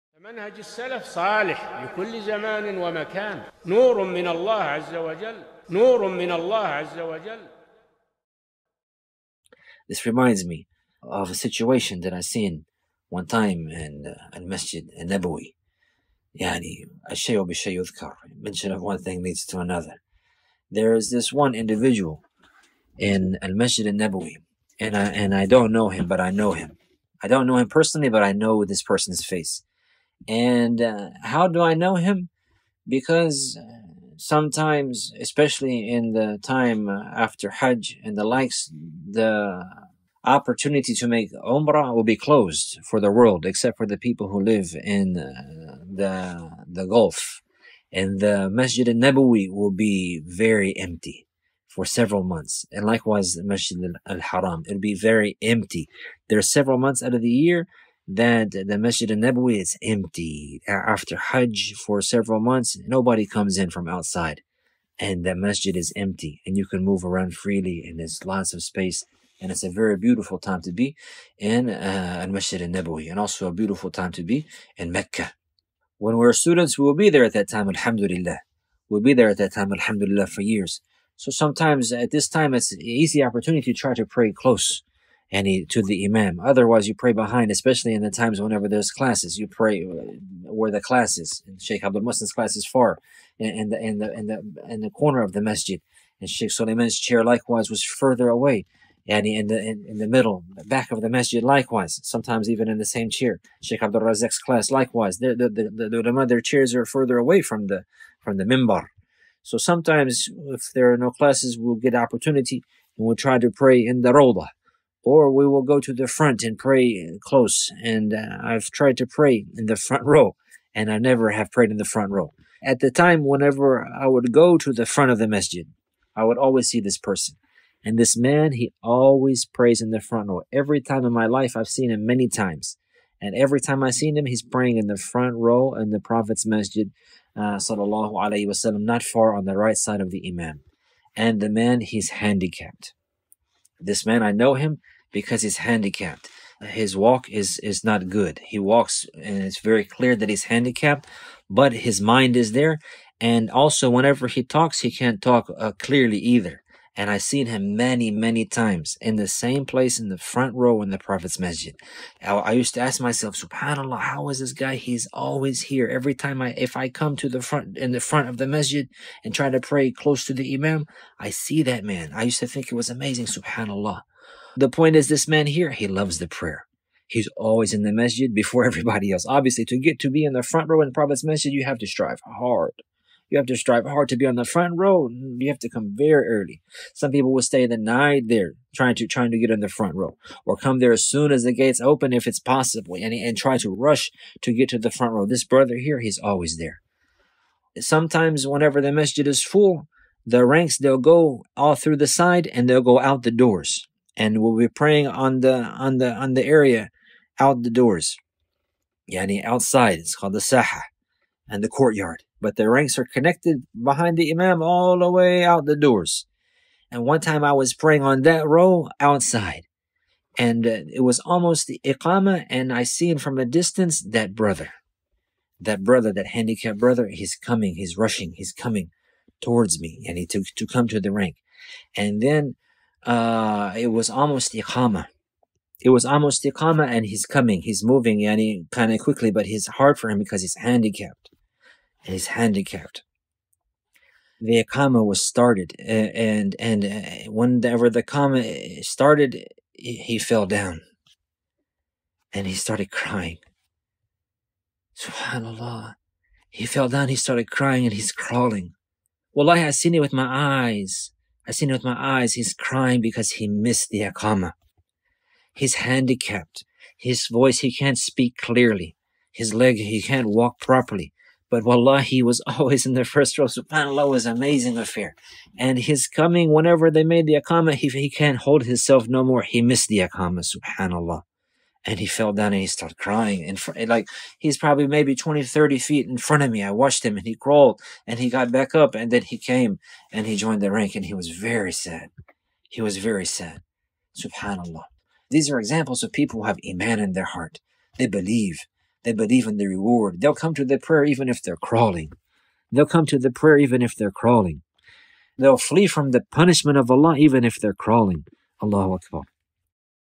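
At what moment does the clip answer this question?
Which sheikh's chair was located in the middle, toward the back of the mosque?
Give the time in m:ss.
1:36.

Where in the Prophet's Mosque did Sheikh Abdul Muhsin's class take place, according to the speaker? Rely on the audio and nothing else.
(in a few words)
In the corner.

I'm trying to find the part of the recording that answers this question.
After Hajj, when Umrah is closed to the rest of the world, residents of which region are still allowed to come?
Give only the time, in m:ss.
0:46.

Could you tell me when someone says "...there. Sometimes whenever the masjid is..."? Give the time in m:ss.
3:16.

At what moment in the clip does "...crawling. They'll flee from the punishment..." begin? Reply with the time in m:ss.
5:04.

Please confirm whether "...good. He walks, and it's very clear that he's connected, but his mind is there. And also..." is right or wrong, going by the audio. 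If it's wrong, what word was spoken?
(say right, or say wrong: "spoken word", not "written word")
wrong: "handicapped", not "connected".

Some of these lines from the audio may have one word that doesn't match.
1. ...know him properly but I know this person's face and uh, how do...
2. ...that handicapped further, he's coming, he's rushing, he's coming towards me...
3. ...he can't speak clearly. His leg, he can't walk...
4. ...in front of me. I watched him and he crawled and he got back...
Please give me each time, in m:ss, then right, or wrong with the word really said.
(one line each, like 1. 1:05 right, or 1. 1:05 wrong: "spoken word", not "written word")
1. 0:27 wrong: "personally", not "properly"
2. 3:46 wrong: "brother", not "further"
3. 4:27 right
4. 4:46 right.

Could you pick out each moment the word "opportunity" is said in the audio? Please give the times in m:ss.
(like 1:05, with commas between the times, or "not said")
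0:40, 1:23, 1:51.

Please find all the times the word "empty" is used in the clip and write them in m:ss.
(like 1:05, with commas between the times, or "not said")
0:50, 0:55, 0:59, 1:05.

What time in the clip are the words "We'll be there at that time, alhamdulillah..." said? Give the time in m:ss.
1:18.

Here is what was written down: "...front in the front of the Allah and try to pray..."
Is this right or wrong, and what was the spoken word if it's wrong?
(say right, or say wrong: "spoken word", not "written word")
wrong: "Masjid", not "Allah".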